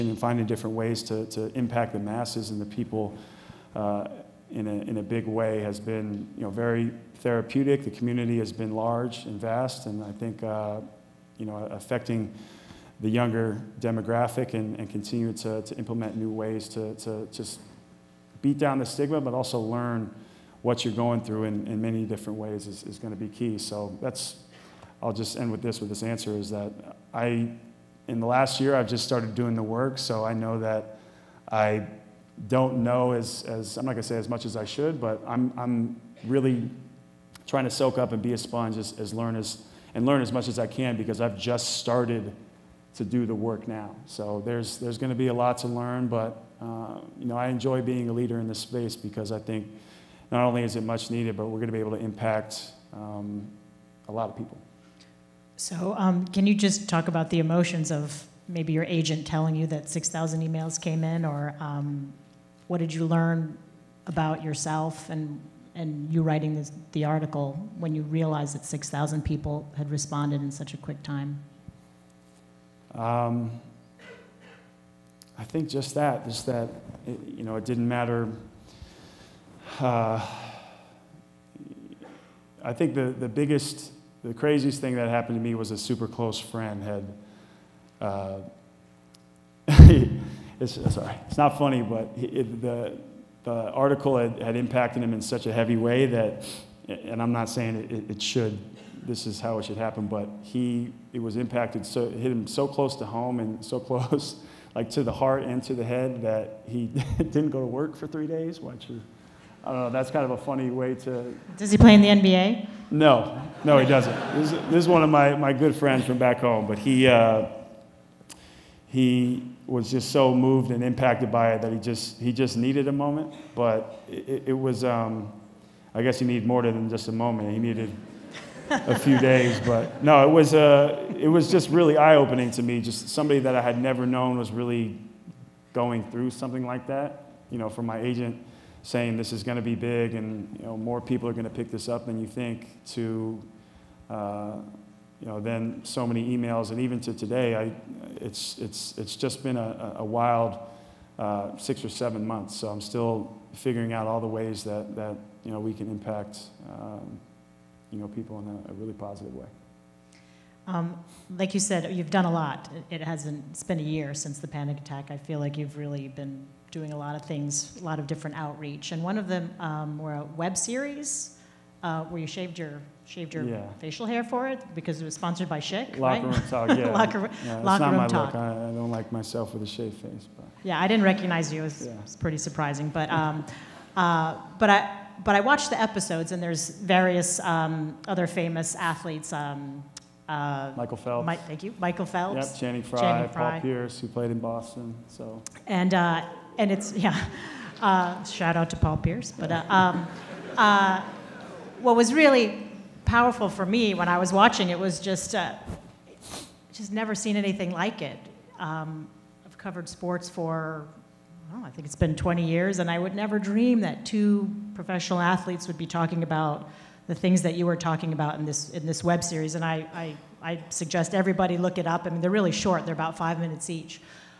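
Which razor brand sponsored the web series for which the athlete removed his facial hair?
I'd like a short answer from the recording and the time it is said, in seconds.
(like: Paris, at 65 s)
Schick, at 175 s.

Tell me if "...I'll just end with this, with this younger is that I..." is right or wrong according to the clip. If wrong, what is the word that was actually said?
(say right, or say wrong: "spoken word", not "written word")
wrong: "answer", not "younger".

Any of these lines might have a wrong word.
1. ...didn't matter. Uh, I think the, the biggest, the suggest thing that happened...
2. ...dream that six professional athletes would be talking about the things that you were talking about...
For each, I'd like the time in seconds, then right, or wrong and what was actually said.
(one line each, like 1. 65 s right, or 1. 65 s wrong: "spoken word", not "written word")
1. 77 s wrong: "craziest", not "suggest"
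2. 213 s wrong: "two", not "six".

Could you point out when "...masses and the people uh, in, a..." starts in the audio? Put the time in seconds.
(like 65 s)
1 s.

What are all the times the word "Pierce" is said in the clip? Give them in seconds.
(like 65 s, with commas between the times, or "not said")
193 s, 198 s.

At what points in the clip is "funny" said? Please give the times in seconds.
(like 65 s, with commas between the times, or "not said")
91 s, 110 s.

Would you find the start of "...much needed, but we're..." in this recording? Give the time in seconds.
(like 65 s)
50 s.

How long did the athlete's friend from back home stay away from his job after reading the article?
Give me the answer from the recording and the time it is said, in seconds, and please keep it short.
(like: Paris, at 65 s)
three days, at 108 s.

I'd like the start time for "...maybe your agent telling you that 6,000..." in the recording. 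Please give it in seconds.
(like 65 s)
58 s.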